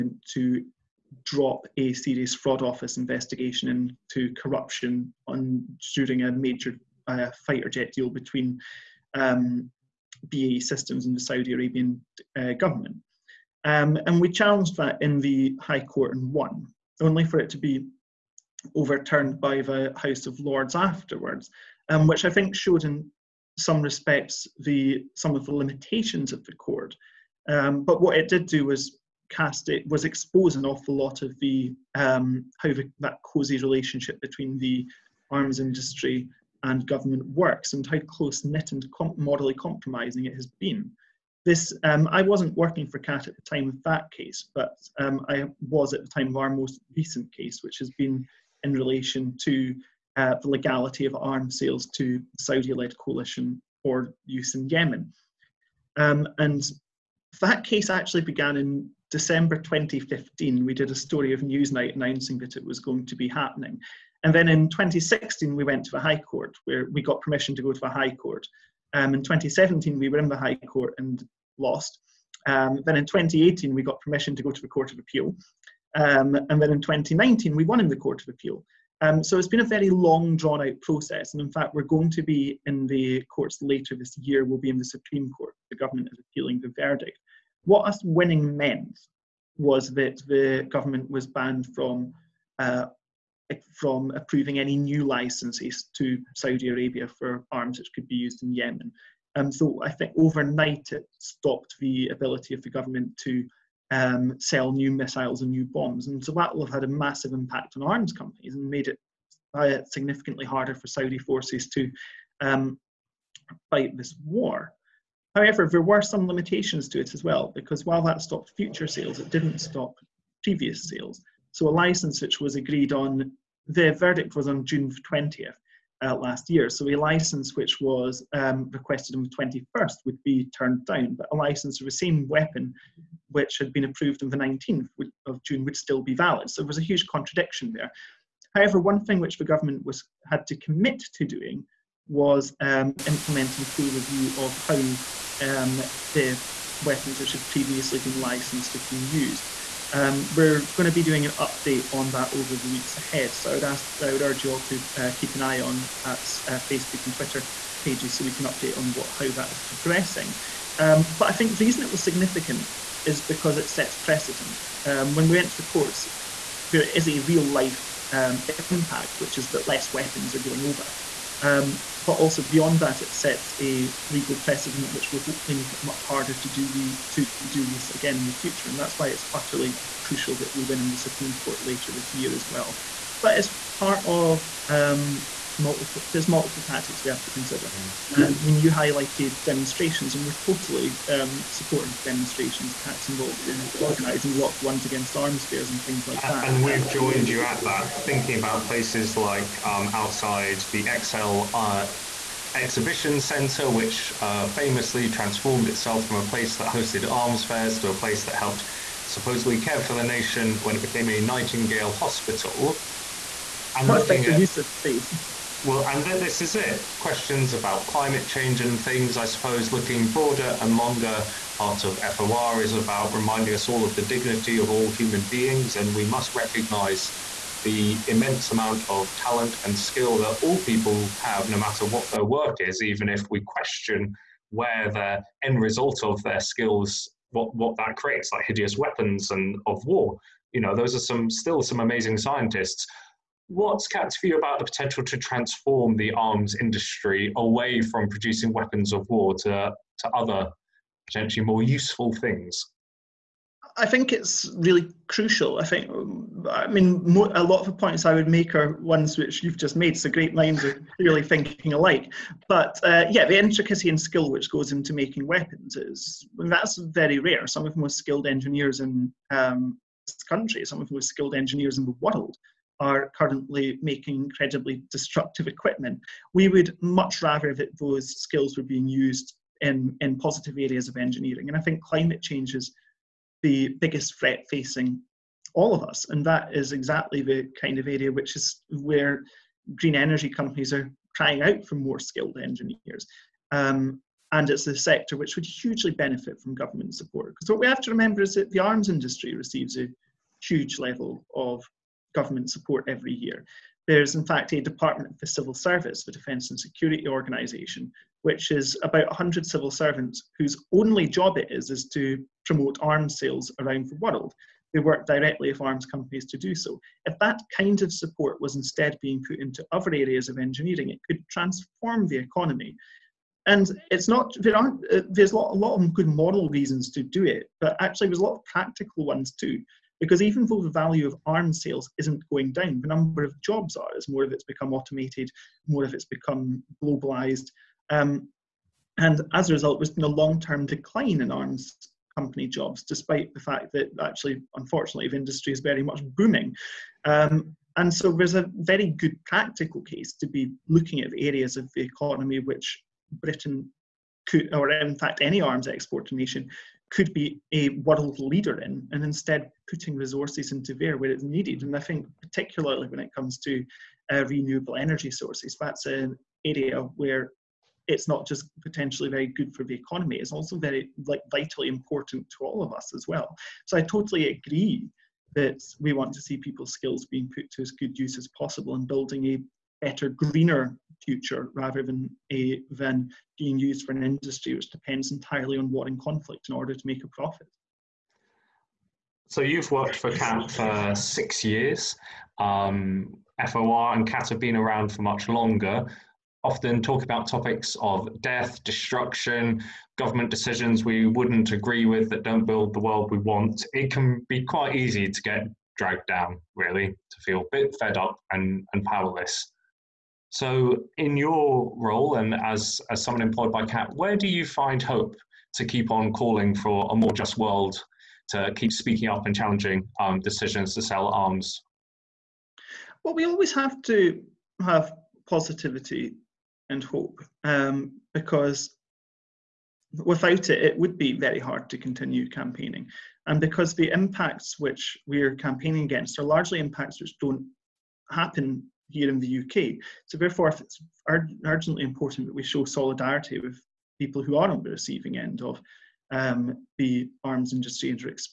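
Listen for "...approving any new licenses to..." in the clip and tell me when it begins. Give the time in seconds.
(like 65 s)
94 s.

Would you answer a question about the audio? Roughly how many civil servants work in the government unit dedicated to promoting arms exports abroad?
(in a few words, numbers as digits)
100.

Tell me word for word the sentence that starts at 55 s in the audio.
Um, and that case actually began in December 2015.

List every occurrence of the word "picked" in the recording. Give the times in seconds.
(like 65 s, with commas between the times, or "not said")
not said.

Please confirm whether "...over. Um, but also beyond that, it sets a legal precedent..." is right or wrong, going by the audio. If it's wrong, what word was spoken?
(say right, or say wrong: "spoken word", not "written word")
right.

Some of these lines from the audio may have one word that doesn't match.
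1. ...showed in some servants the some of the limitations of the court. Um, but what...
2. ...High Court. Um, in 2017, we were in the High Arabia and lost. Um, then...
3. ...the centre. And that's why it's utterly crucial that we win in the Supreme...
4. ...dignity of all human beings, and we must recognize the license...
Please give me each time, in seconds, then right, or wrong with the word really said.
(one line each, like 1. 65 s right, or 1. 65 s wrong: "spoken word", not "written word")
1. 22 s wrong: "respects", not "servants"
2. 67 s wrong: "Court", not "Arabia"
3. 178 s wrong: "future", not "centre"
4. 224 s wrong: "immense", not "license".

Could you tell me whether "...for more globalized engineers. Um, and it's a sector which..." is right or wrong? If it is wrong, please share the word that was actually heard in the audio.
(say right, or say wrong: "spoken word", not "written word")
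wrong: "skilled", not "globalized".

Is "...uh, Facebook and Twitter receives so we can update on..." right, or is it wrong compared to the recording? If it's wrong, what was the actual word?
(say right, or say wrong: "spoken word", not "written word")
wrong: "pages", not "receives".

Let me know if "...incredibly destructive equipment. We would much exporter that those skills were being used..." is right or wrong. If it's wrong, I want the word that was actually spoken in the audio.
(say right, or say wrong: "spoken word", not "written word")
wrong: "rather", not "exporter".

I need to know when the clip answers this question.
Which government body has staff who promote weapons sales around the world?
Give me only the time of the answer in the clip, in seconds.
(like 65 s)
306 s.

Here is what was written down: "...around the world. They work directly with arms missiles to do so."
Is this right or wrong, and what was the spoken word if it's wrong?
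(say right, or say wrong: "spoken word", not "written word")
wrong: "companies", not "missiles".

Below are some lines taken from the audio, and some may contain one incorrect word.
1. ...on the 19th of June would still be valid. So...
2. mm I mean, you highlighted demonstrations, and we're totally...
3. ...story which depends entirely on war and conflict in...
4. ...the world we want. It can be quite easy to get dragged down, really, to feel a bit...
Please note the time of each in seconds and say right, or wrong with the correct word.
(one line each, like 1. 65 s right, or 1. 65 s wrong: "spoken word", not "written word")
1. 134 s right
2. 187 s right
3. 384 s wrong: "industry", not "story"
4. 402 s right.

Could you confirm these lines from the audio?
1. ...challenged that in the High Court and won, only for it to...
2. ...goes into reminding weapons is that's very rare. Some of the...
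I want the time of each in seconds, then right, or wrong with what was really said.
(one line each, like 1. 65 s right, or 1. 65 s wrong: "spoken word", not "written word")
1. 14 s right
2. 264 s wrong: "making", not "reminding".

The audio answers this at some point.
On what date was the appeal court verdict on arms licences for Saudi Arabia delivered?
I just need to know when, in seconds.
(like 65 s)
124 s.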